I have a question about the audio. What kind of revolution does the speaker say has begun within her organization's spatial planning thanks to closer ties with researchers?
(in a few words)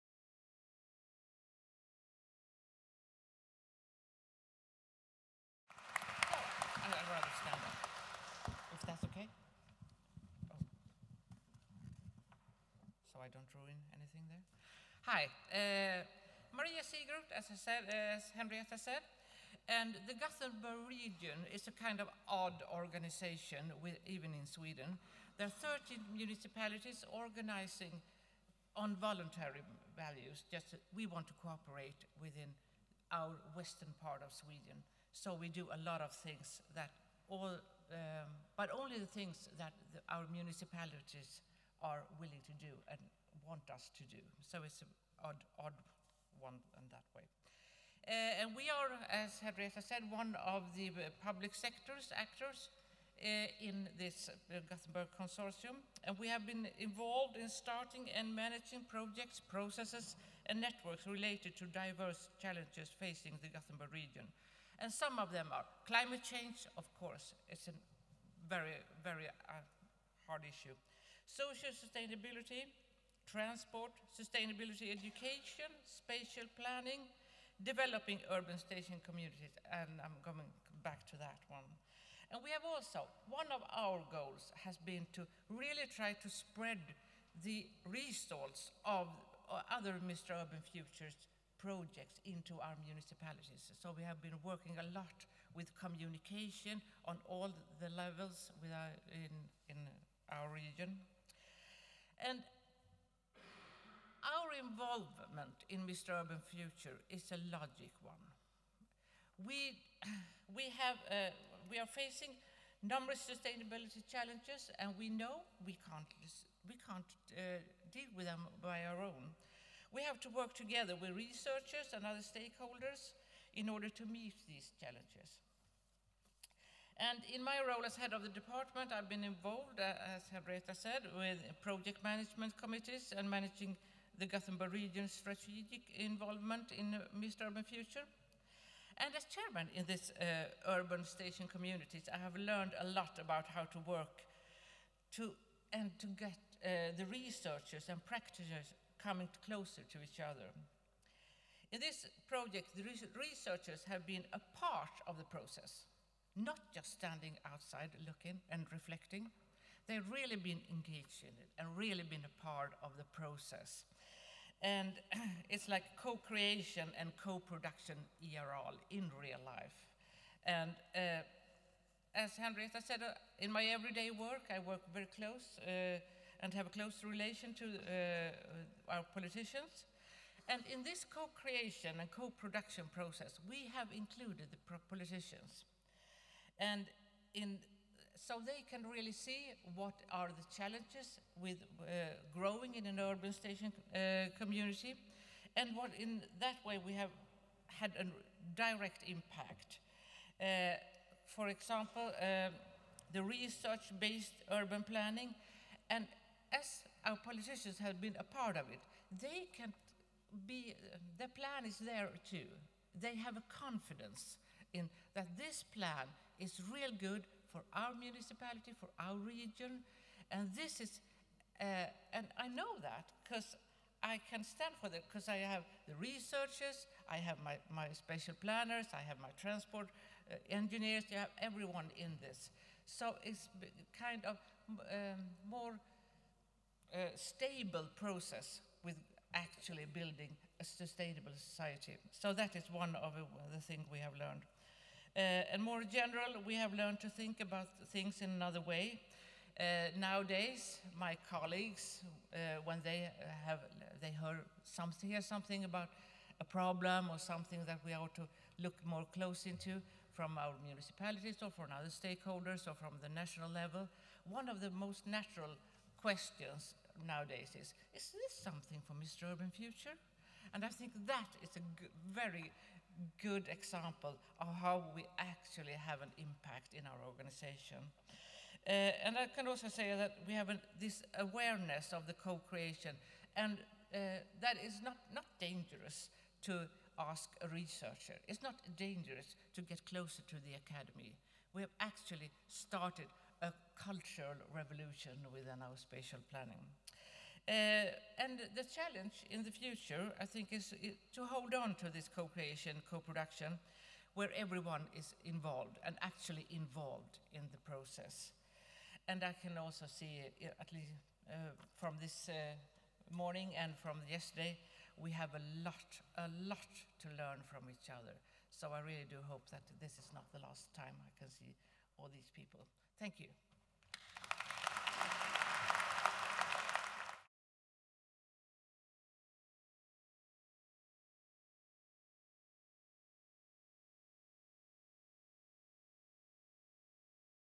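Cultural revolution.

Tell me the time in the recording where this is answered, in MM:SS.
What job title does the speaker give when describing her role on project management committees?
02:07.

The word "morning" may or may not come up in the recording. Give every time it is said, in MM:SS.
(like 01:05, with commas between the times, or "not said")
05:13.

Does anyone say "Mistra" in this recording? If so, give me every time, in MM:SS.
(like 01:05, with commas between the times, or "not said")
01:30, 02:17, 04:28.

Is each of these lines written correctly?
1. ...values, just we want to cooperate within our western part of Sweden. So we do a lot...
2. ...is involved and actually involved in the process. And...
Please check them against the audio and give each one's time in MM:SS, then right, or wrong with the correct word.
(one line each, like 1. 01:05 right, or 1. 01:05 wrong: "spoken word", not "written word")
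1. 00:29 right
2. 05:04 right.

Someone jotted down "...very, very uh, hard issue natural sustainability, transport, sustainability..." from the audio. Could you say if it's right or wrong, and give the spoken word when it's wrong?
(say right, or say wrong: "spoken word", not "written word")
wrong: "social", not "natural".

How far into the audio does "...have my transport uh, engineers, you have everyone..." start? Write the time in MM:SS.
03:49.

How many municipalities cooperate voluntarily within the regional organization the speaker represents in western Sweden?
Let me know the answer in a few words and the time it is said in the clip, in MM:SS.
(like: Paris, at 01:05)
13, at 00:25.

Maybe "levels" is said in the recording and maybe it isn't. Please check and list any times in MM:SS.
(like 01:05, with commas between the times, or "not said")
01:37, 04:23.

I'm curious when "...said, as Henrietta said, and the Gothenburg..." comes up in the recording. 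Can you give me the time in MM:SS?
00:17.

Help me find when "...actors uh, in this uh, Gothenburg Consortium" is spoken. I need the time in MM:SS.
00:52.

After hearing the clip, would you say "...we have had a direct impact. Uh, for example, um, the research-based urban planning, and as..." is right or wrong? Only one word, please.
right.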